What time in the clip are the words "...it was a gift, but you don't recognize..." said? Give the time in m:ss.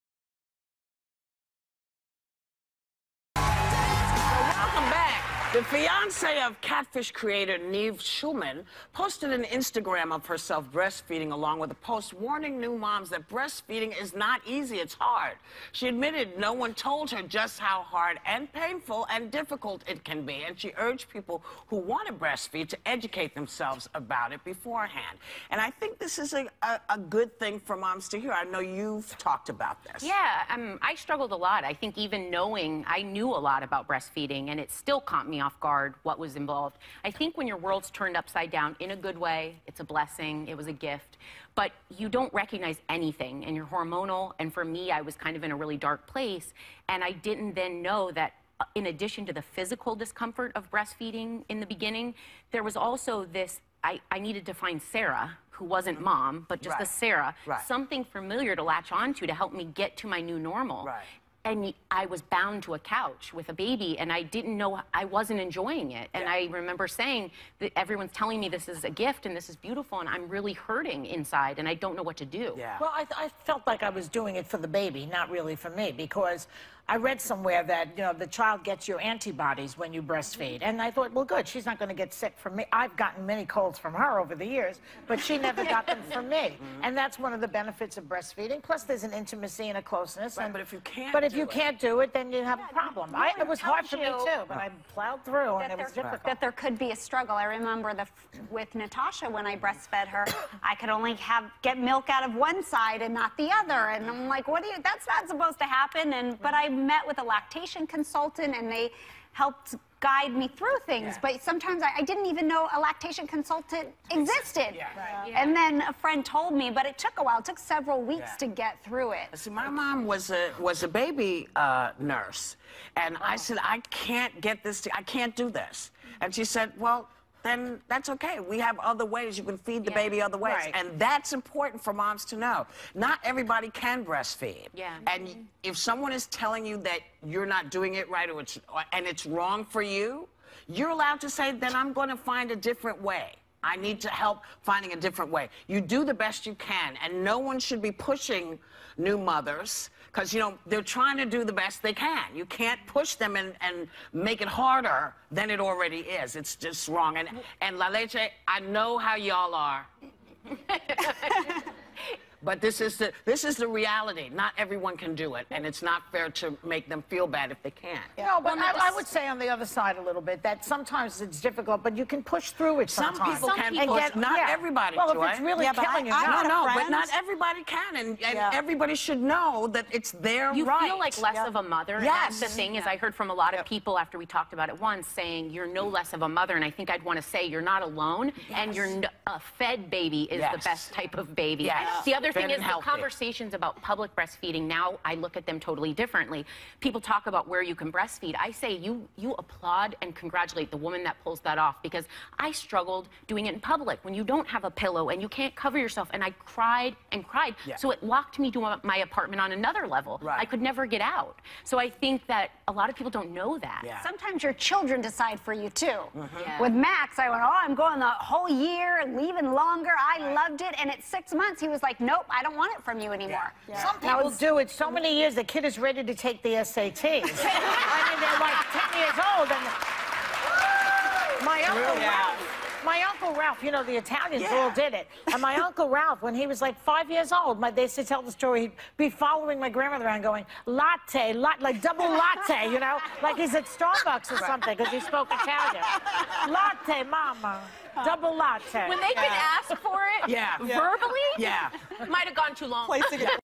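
0:40.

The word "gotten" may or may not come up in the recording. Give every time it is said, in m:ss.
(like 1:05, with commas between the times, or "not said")
1:22.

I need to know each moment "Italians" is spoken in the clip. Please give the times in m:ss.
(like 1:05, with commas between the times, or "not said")
3:53, 4:05.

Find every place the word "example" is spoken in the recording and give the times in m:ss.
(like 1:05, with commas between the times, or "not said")
not said.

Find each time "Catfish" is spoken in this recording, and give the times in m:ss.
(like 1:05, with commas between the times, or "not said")
0:06.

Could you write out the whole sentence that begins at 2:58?
everybody should know that it's their you right.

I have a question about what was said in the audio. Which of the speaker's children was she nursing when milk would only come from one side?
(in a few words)
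Natasha.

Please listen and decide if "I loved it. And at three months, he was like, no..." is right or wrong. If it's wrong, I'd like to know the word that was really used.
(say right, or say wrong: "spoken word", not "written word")
wrong: "six", not "three".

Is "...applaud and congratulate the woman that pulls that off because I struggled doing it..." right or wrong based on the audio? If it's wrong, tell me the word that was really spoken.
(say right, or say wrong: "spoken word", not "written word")
right.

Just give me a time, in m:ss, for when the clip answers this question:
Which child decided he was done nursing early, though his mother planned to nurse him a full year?
3:36.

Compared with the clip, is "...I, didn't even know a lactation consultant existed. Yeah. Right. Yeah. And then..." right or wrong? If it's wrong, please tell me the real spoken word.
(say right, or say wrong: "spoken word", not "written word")
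right.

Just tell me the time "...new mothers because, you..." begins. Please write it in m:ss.
2:28.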